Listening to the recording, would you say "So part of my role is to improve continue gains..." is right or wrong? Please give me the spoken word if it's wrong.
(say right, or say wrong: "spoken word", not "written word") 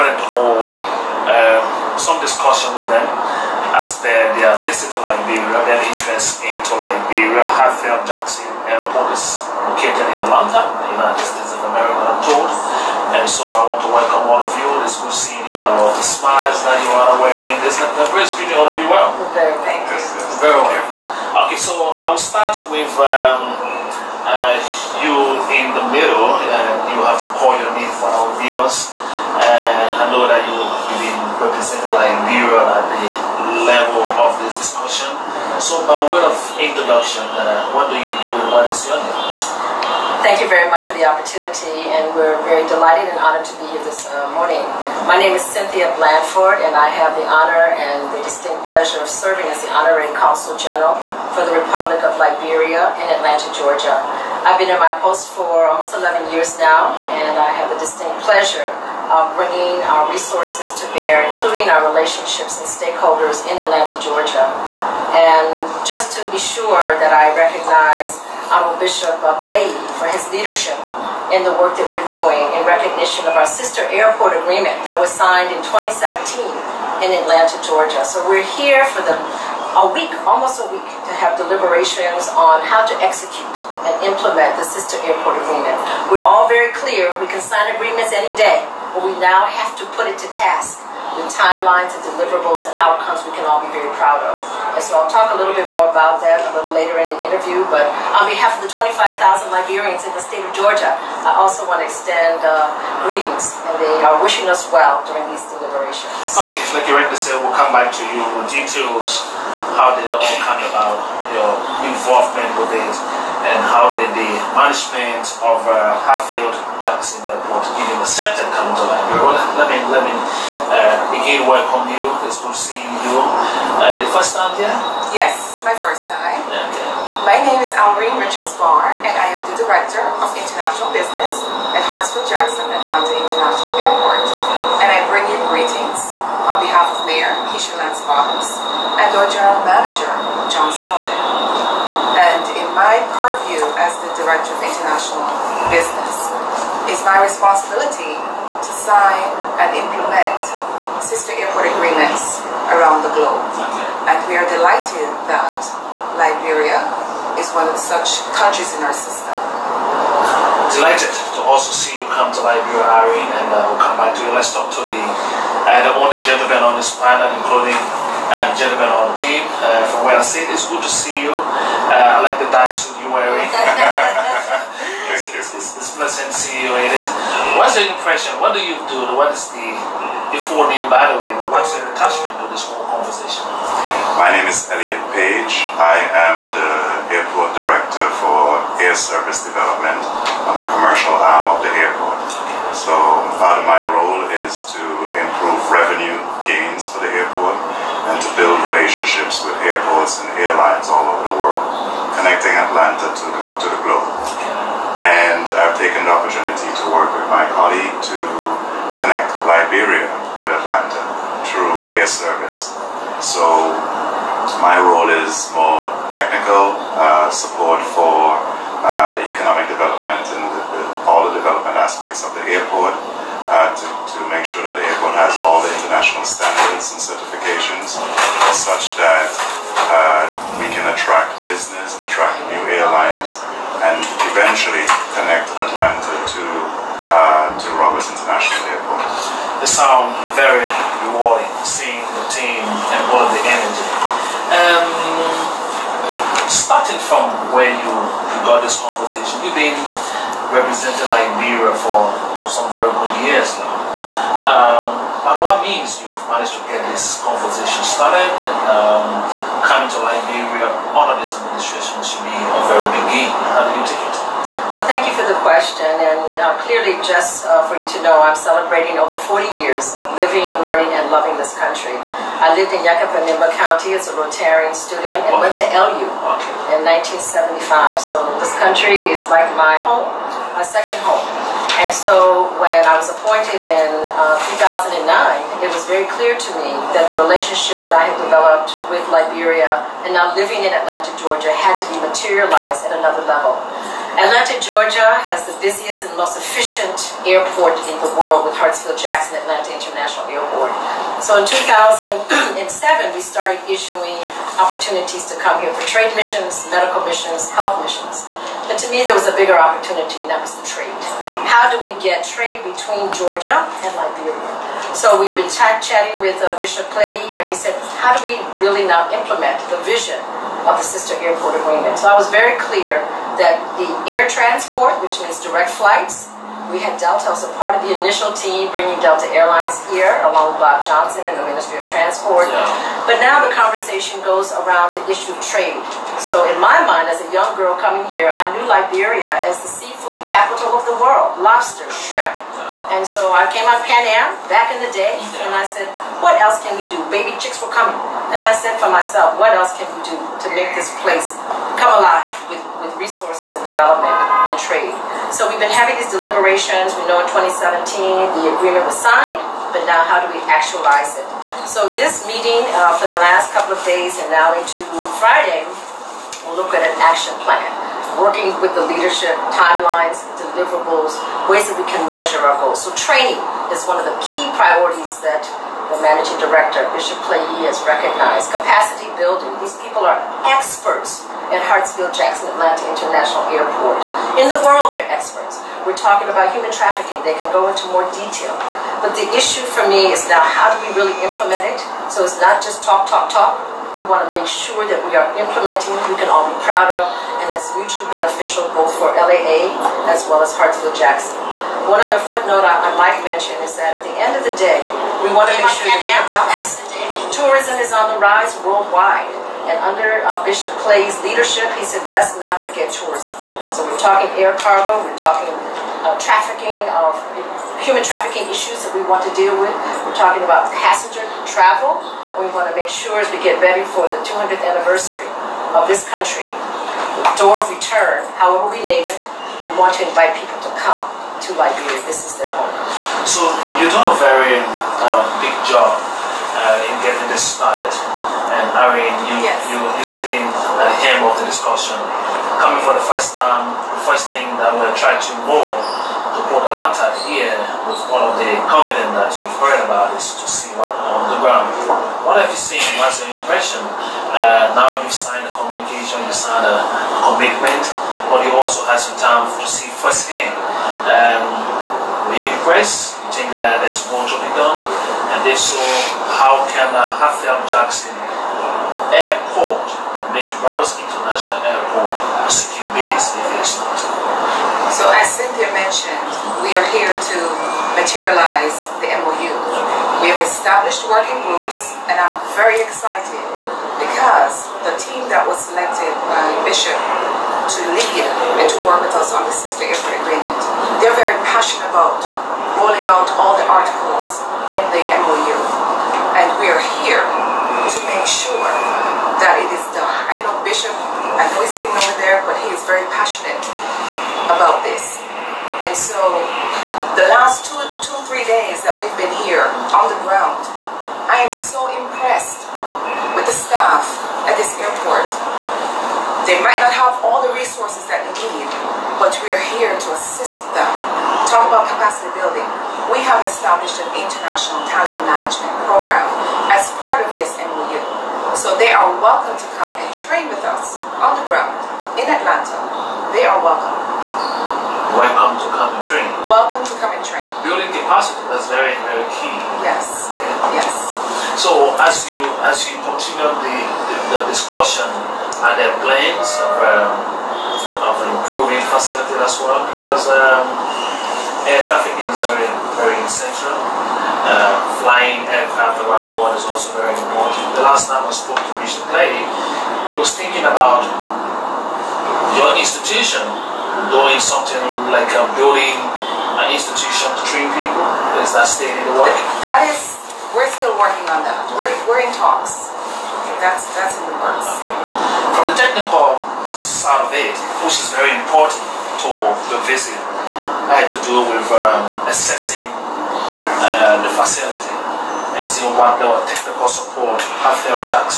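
wrong: "revenue", not "continue".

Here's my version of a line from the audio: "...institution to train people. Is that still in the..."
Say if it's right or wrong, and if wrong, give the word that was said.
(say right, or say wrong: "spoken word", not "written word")
right.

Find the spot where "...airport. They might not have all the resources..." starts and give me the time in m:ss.
8:34.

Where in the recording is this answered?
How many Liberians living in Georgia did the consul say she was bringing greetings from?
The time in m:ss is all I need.
1:38.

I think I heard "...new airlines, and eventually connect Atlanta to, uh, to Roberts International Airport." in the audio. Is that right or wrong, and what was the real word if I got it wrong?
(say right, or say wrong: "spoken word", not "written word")
right.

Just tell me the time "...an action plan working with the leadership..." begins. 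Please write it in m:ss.
6:06.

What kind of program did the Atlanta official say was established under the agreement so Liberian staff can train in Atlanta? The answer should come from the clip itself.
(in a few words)
international talent management program.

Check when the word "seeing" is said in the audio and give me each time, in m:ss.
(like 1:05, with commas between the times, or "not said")
0:15, 2:02, 2:56, 9:45.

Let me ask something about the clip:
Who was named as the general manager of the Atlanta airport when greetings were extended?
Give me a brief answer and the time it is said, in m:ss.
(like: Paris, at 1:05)
John Selden, at 2:20.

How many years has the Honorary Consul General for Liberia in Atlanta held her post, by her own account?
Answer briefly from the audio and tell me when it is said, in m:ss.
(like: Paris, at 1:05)
almost 11 years, at 0:55.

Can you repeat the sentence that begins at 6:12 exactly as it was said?
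So training is one of the key priorities that the managing director, Bishop Clay has recognized.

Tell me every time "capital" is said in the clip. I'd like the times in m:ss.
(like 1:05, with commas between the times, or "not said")
5:40.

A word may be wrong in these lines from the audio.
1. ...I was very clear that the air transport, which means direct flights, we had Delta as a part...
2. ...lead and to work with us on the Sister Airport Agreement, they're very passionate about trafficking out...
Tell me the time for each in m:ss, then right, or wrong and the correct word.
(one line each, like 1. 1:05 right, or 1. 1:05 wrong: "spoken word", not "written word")
1. 5:22 right
2. 8:07 wrong: "rolling", not "trafficking".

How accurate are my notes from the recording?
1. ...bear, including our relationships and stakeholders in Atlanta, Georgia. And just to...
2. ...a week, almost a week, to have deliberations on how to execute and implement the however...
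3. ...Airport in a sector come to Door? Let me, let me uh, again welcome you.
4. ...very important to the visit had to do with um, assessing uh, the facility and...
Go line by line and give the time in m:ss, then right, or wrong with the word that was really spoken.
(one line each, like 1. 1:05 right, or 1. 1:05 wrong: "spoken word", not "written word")
1. 1:00 right
2. 1:19 wrong: "sister", not "however"
3. 1:57 wrong: "Liberia", not "Door"
4. 9:38 right.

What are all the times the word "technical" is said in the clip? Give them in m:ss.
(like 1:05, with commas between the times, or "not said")
3:36, 9:35, 9:46.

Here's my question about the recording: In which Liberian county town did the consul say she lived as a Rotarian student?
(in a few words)
Yekepa.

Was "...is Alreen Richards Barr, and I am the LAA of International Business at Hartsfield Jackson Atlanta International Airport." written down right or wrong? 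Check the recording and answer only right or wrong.
wrong.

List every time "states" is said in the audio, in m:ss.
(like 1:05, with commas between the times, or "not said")
0:11, 1:40.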